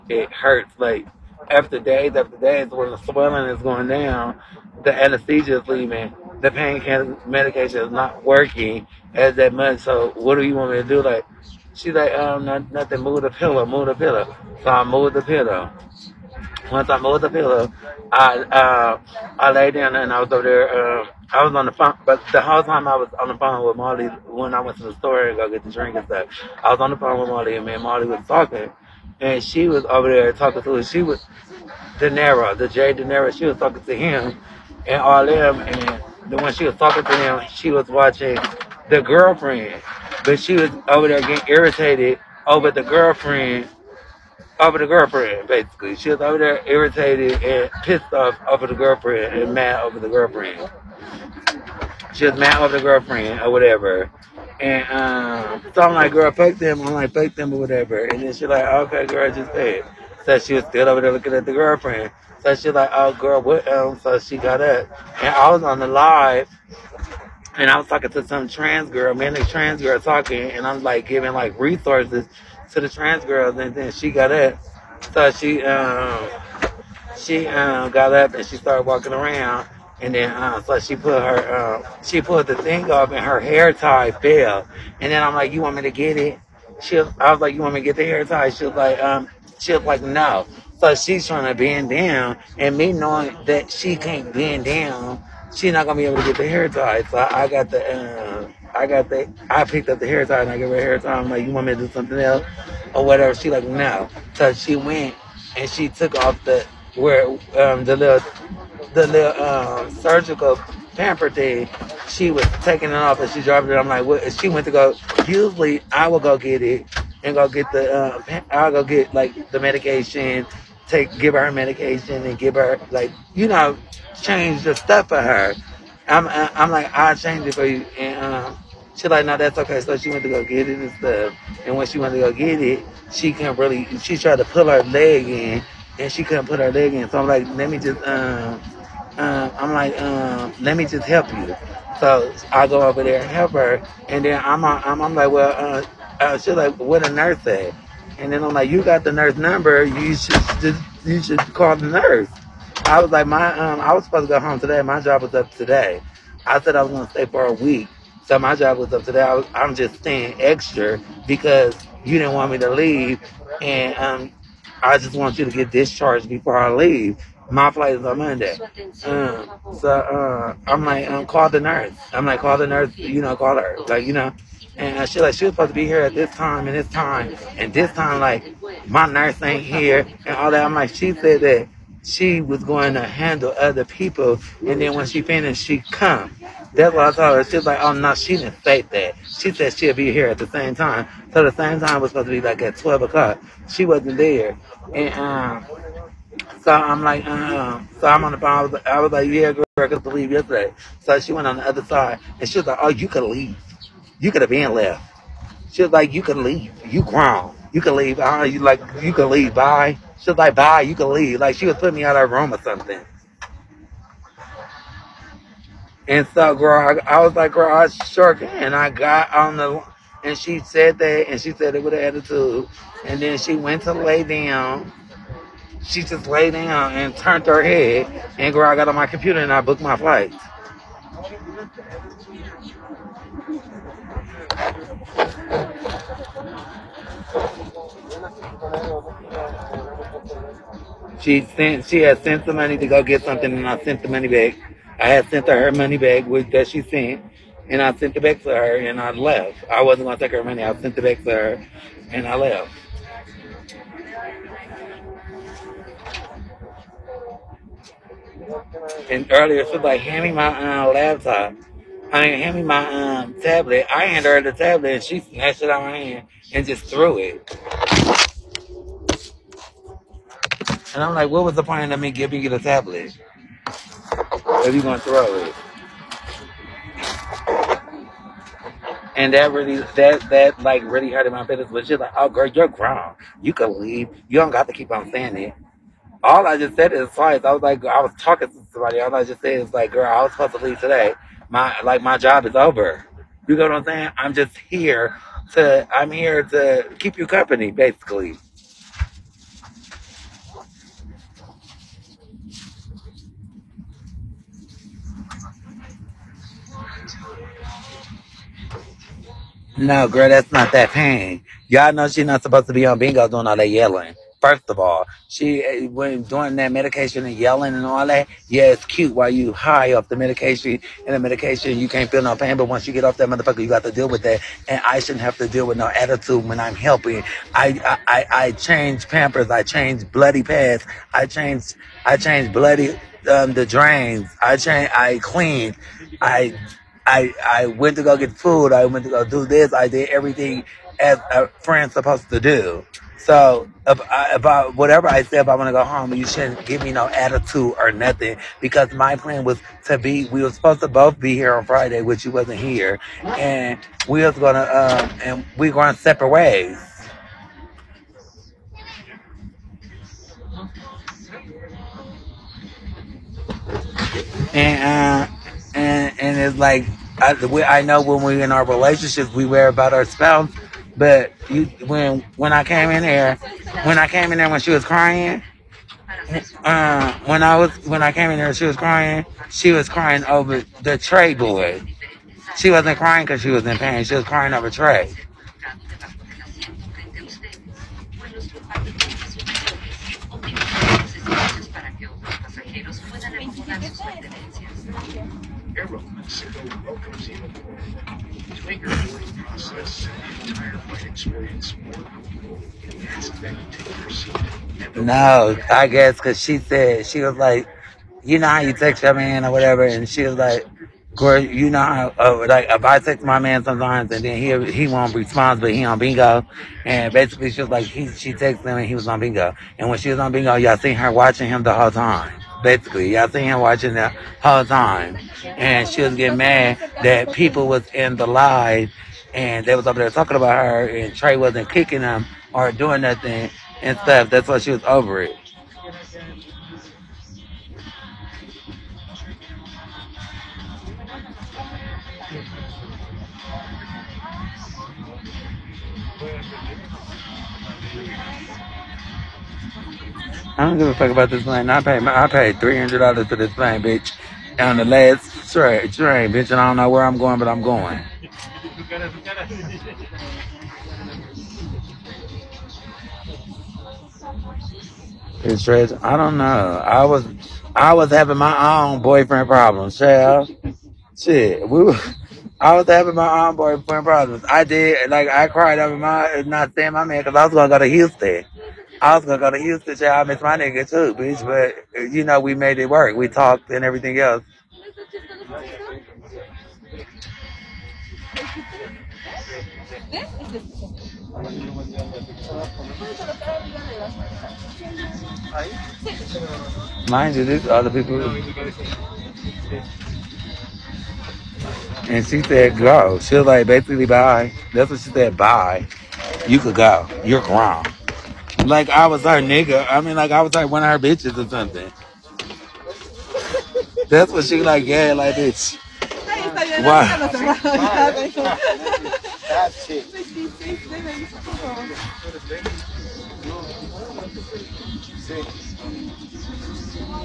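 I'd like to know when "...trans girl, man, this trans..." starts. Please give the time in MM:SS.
01:08.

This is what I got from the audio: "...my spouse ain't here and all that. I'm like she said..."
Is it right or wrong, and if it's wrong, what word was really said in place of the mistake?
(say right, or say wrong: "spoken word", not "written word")
wrong: "nurse", not "spouse".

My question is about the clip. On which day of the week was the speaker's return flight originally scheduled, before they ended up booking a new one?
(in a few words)
Monday.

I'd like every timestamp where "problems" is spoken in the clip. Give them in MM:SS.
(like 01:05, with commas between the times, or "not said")
07:49, 07:54.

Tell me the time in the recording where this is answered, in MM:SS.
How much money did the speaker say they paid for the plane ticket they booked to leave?
07:32.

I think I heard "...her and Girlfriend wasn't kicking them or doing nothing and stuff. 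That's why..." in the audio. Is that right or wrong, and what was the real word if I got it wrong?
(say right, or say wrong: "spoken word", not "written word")
wrong: "Trey", not "Girlfriend".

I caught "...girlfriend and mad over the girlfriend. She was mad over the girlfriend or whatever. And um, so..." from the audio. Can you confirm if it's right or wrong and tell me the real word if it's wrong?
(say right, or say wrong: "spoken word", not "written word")
right.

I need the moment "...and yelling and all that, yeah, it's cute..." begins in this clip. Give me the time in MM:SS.
05:17.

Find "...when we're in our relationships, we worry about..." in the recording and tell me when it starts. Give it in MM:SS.
06:08.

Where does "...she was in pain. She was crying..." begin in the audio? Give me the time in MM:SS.
06:23.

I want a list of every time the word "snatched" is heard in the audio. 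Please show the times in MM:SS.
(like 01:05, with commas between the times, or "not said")
04:25.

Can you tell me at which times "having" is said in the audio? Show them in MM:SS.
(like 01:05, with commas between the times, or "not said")
07:48, 07:52.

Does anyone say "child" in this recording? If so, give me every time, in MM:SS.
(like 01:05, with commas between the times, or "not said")
07:49, 07:59.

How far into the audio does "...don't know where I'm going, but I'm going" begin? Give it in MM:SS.
07:36.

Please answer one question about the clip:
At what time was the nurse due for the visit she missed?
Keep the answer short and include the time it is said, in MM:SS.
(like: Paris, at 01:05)
12 o'clock, at 03:12.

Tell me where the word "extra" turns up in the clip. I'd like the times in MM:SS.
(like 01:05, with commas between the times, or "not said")
02:40.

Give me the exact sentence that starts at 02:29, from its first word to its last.
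You should, you should call the nurse.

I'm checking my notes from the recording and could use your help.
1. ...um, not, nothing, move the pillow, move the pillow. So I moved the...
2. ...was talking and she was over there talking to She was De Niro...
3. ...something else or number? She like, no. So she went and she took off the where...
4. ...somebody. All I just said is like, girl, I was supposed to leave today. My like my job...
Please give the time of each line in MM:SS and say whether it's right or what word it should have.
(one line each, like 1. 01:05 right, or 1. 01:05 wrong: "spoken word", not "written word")
1. 00:12 right
2. 00:28 right
3. 01:41 wrong: "whatever", not "number"
4. 04:48 right.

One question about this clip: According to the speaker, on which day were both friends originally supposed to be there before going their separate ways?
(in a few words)
Friday.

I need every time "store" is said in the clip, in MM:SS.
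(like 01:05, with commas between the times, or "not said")
00:24.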